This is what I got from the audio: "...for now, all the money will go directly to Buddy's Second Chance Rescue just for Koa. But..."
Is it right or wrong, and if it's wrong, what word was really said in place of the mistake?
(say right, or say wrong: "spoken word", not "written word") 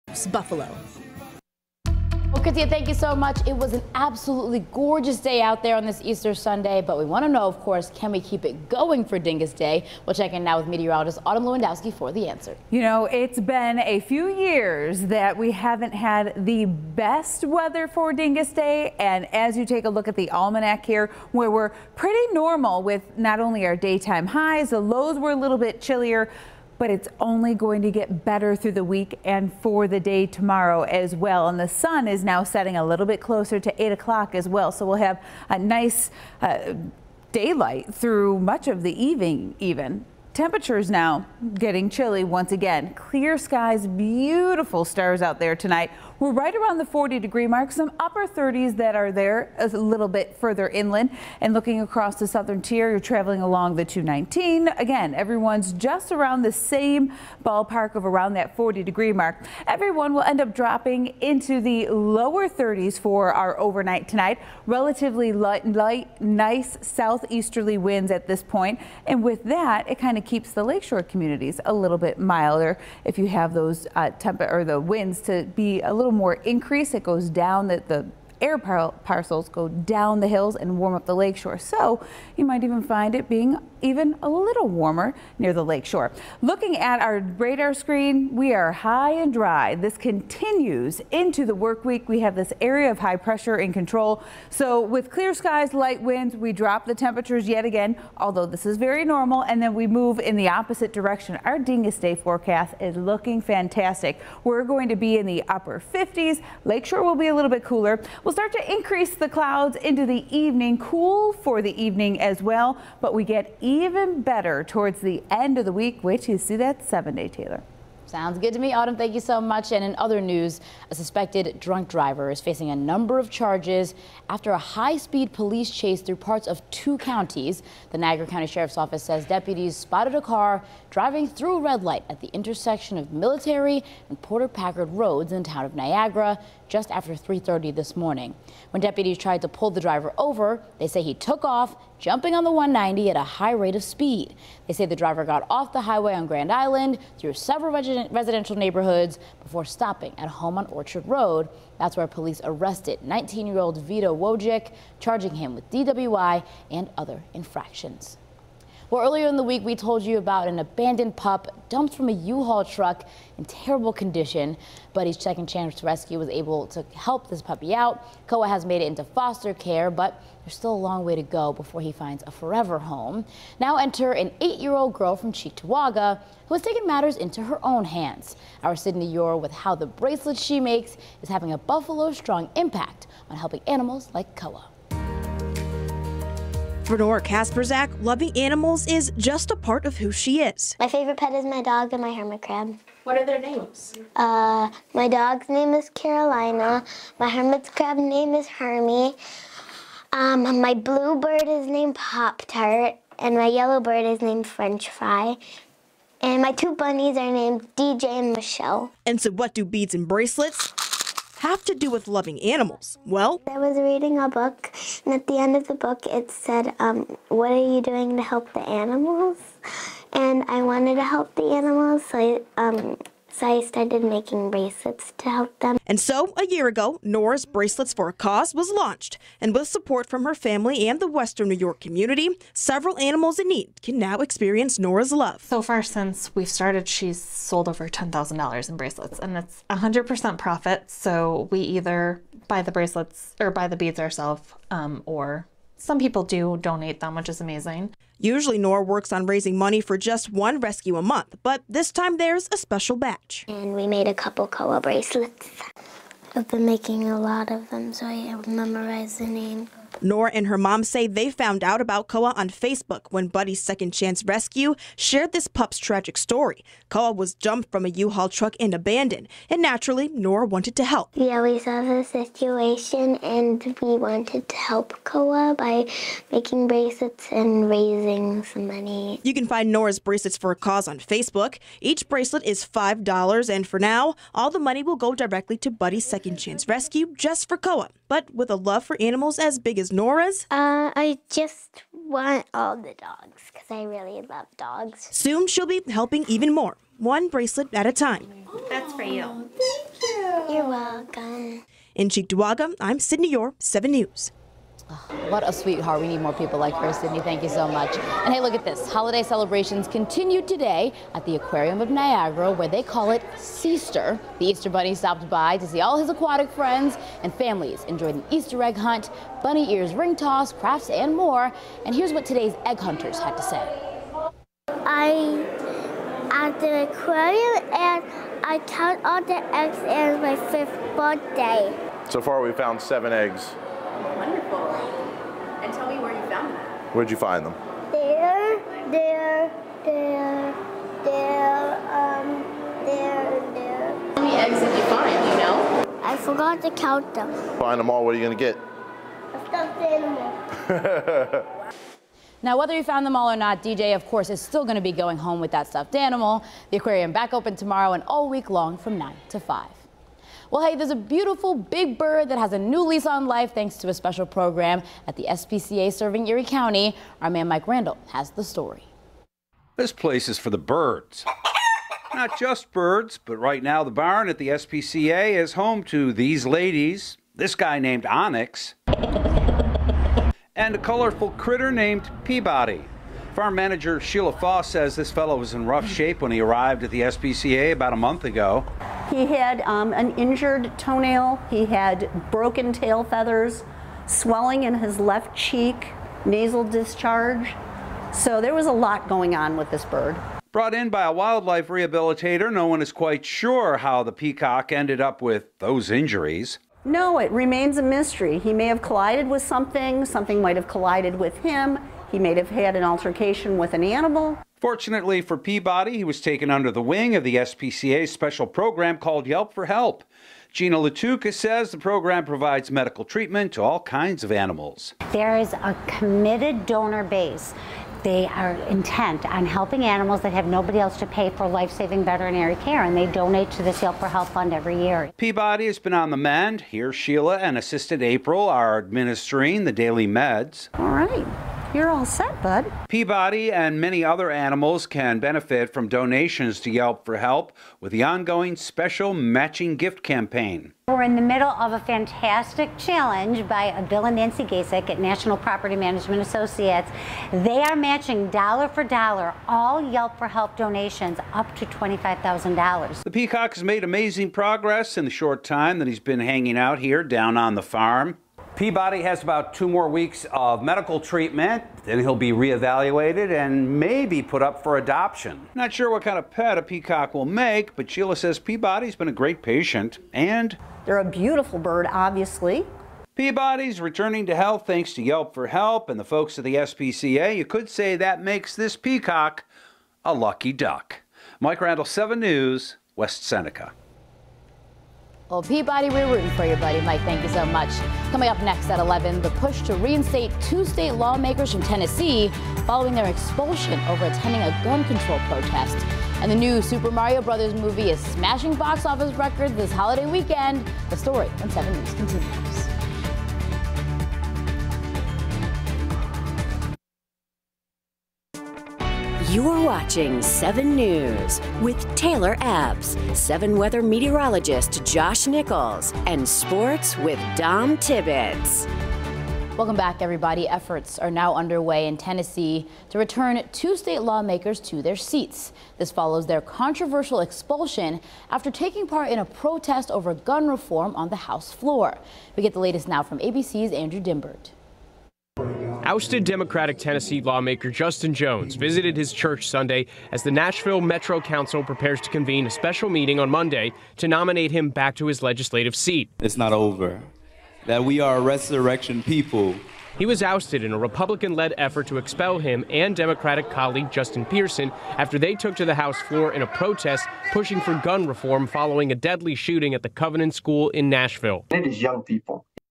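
right.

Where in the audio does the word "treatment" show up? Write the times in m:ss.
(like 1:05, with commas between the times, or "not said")
7:03, 7:50.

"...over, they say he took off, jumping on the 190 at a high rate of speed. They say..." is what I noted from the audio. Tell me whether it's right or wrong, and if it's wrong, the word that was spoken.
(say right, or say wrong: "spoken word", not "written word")
right.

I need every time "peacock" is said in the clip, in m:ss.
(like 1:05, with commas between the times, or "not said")
6:44, 7:43, 7:56, 8:08.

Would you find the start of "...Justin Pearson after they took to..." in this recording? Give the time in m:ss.
9:23.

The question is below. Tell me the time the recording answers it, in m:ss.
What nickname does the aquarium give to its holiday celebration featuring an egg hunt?
5:13.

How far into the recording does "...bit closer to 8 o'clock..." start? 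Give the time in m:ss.
0:33.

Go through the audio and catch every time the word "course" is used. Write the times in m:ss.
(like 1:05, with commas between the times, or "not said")
0:07, 5:54.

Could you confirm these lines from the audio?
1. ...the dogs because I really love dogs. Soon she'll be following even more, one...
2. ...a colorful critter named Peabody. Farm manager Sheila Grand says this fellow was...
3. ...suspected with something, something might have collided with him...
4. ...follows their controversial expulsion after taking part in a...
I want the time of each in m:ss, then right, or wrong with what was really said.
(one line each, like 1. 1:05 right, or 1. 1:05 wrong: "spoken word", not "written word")
1. 4:52 wrong: "helping", not "following"
2. 6:20 wrong: "Foss", not "Grand"
3. 6:48 wrong: "collided", not "suspected"
4. 8:55 right.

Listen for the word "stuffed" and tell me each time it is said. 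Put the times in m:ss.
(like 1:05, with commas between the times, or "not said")
5:49, 5:55.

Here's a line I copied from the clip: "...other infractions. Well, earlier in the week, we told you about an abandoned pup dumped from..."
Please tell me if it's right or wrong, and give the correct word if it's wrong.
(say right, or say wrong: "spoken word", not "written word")
right.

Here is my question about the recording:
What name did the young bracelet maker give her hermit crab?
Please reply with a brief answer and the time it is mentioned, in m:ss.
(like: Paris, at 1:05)
Hermie, at 3:18.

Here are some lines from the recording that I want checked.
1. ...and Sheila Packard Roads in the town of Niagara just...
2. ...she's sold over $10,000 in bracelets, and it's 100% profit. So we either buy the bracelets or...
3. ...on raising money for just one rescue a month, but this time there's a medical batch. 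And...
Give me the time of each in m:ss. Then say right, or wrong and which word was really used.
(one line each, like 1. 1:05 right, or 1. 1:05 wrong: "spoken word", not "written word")
1. 2:14 wrong: "Porter", not "Sheila"
2. 3:56 right
3. 4:09 wrong: "special", not "medical".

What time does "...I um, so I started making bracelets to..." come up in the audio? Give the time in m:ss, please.
3:42.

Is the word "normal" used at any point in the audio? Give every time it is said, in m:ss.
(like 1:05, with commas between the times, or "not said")
0:22, 1:39.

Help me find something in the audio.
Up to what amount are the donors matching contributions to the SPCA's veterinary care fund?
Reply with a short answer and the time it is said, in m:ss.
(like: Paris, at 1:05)
$25,000, at 7:41.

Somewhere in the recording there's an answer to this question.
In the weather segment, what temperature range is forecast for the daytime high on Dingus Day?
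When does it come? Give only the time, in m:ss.
1:45.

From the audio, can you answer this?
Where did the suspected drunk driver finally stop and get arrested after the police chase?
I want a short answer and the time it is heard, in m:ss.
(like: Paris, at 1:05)
Orchard Road, at 2:30.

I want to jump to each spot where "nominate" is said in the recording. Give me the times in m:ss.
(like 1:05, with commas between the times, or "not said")
9:14.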